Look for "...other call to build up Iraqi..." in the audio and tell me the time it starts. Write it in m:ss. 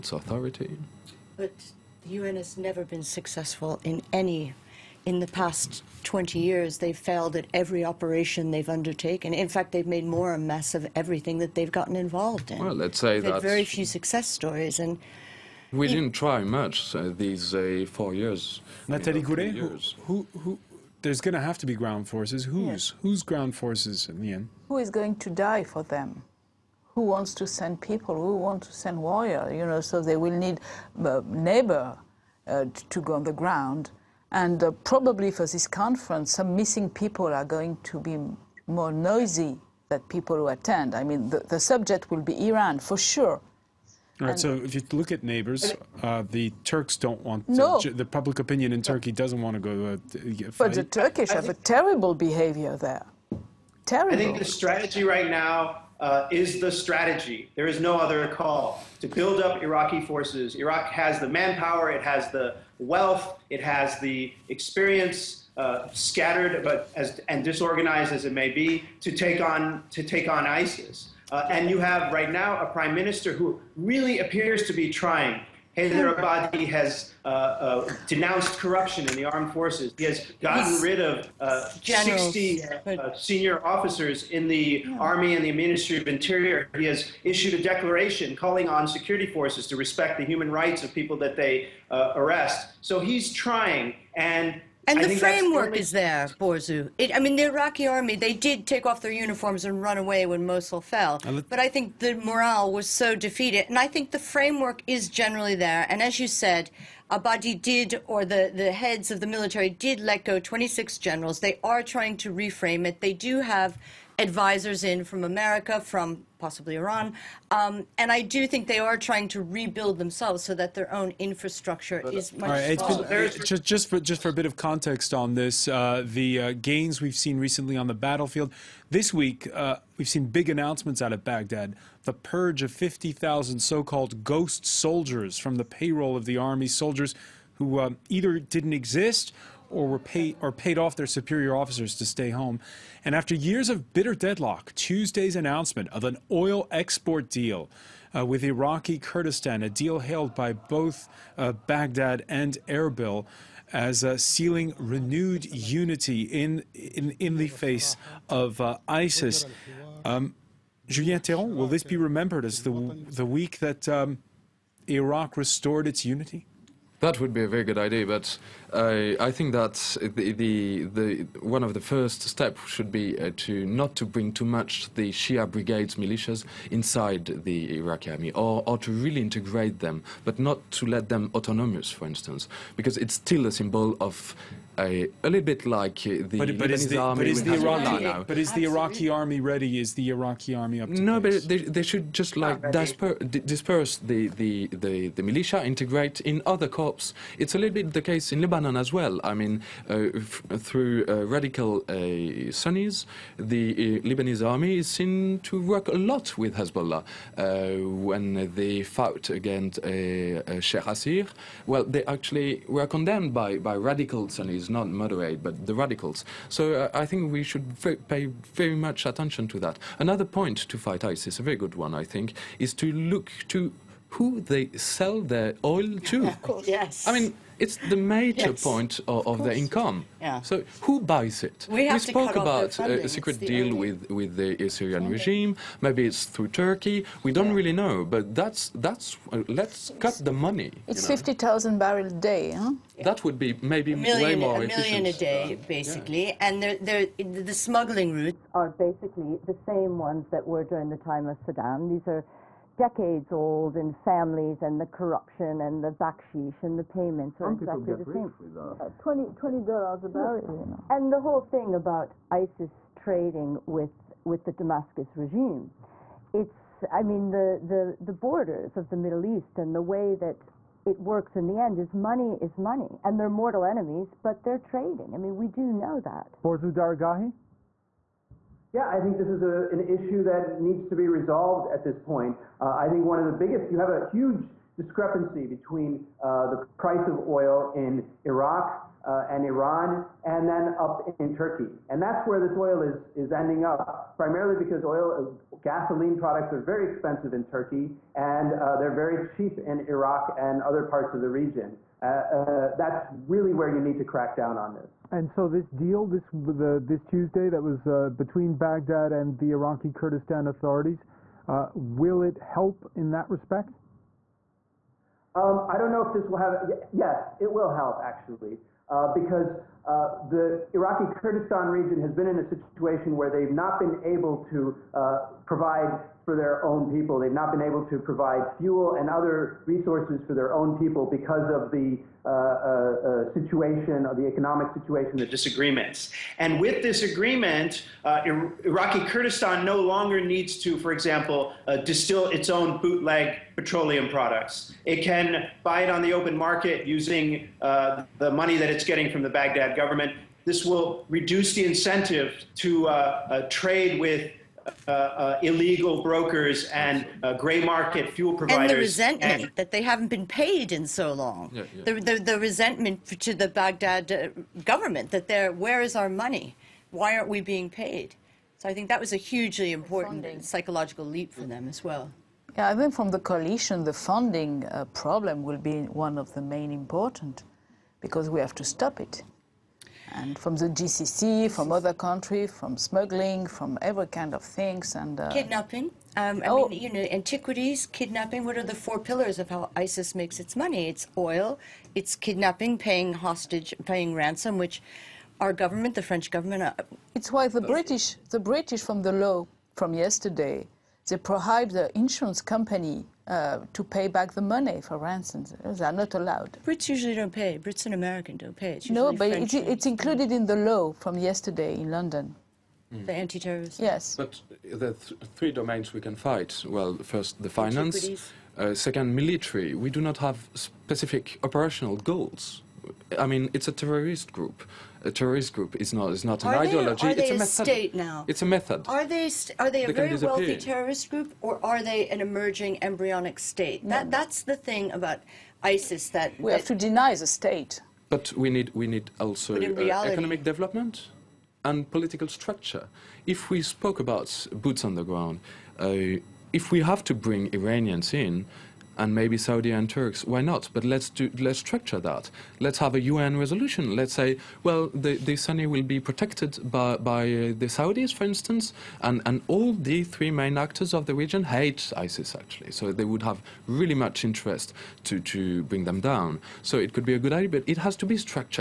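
0:57.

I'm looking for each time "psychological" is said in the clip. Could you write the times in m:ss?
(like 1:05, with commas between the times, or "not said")
6:10.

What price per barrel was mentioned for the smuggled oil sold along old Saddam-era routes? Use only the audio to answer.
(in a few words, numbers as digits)
$20.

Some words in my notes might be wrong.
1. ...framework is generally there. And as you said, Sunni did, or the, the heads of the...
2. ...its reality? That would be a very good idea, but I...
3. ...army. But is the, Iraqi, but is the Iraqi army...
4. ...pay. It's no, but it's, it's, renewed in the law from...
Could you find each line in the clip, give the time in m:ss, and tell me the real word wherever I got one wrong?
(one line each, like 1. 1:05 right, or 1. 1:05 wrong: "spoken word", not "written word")
1. 1:44 wrong: "Abadi", not "Sunni"
2. 2:45 wrong: "unity", not "reality"
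3. 3:06 right
4. 6:48 wrong: "included", not "renewed".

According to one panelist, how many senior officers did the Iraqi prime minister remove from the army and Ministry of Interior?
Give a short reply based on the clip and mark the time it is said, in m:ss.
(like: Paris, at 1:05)
60, at 1:21.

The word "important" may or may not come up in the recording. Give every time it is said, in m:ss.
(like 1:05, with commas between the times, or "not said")
6:09, 6:16.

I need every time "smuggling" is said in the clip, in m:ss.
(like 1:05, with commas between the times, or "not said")
4:07, 6:22.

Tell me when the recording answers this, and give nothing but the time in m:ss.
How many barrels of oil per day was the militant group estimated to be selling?
4:01.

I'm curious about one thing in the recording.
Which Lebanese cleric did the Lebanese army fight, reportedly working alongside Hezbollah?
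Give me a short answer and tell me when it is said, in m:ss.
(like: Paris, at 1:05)
Sheikh Assir, at 3:30.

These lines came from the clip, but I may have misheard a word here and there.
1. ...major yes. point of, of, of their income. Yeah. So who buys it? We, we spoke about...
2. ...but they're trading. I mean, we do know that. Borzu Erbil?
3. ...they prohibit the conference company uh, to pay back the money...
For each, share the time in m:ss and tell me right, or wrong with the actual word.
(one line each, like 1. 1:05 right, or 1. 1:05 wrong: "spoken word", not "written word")
1. 3:48 right
2. 4:34 wrong: "Daragahi", not "Erbil"
3. 6:41 wrong: "insurance", not "conference".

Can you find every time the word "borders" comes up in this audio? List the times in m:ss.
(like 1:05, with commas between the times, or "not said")
4:28.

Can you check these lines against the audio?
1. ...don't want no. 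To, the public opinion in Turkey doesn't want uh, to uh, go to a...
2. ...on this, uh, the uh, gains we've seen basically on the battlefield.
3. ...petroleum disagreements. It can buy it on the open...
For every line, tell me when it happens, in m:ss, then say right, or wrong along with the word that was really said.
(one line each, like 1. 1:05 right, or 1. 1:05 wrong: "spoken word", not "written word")
1. 0:46 right
2. 2:05 wrong: "recently", not "basically"
3. 5:43 wrong: "products", not "disagreements".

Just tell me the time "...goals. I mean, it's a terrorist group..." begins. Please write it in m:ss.
7:01.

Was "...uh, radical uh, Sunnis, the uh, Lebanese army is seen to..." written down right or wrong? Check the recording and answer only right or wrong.
right.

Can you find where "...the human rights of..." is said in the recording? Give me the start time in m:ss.
1:30.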